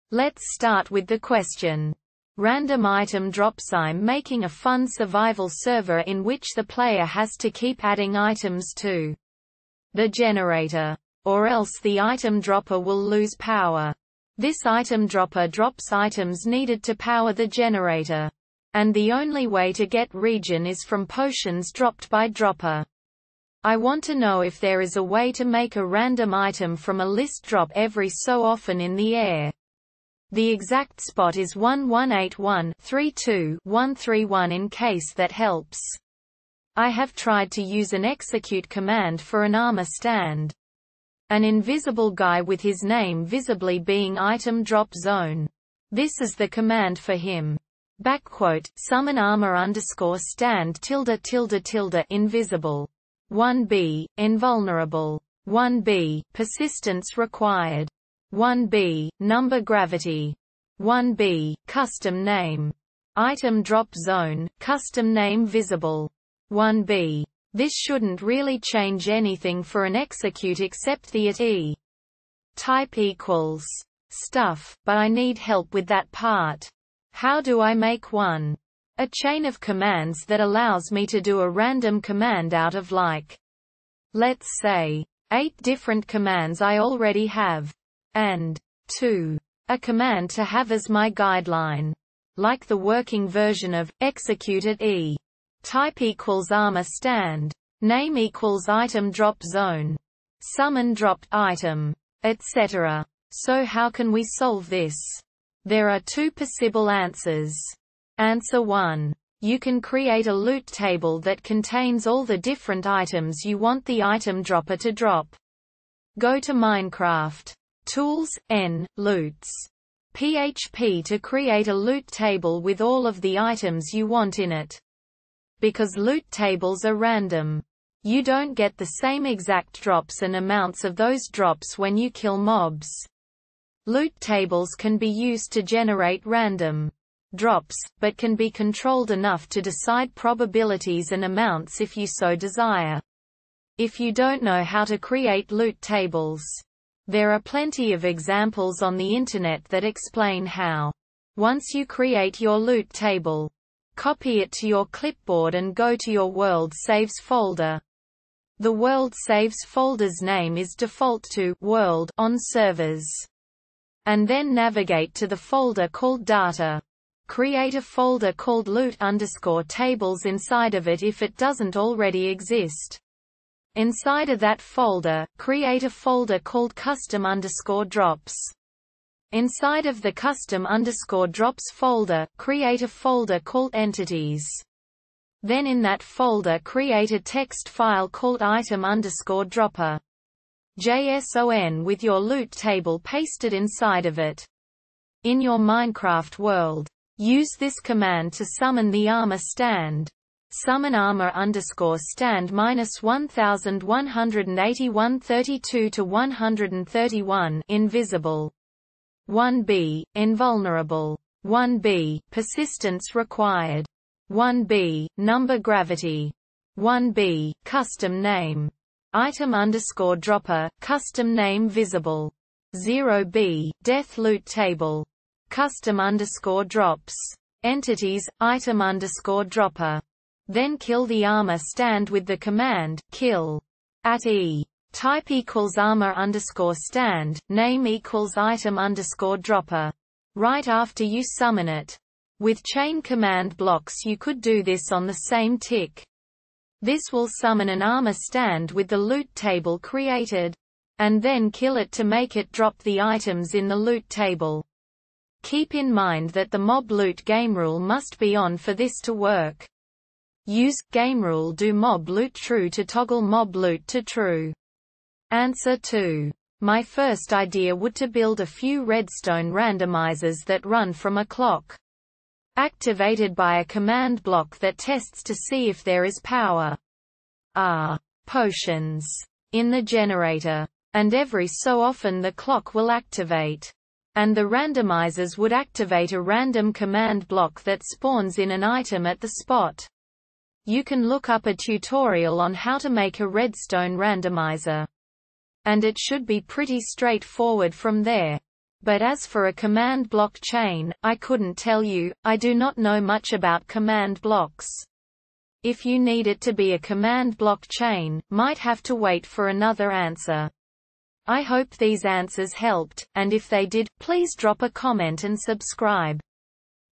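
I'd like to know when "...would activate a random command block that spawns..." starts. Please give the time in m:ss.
4:45.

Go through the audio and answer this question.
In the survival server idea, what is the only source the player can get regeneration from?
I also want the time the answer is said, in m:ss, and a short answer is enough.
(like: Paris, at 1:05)
Potions dropped by dropper, at 0:21.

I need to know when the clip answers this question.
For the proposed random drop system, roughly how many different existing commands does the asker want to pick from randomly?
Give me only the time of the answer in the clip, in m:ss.
1:25.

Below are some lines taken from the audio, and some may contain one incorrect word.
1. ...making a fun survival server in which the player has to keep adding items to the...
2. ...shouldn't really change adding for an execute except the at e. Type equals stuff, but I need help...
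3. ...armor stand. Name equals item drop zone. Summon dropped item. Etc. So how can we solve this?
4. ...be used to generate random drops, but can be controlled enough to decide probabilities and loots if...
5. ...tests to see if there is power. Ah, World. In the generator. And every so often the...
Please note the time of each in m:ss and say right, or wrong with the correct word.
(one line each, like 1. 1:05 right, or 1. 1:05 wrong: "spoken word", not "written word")
1. 0:04 right
2. 1:07 wrong: "anything", not "adding"
3. 1:36 right
4. 2:14 wrong: "amounts", not "loots"
5. 4:34 wrong: "Potions", not "World".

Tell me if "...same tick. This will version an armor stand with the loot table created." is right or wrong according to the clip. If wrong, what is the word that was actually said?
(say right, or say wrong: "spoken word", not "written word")
wrong: "summon", not "version".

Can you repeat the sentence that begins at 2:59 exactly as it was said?
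Inside of the custom underscore drops folder, create a folder called entities.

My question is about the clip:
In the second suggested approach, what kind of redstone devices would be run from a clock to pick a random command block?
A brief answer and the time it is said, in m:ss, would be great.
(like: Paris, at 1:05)
Redstone randomizers, at 4:28.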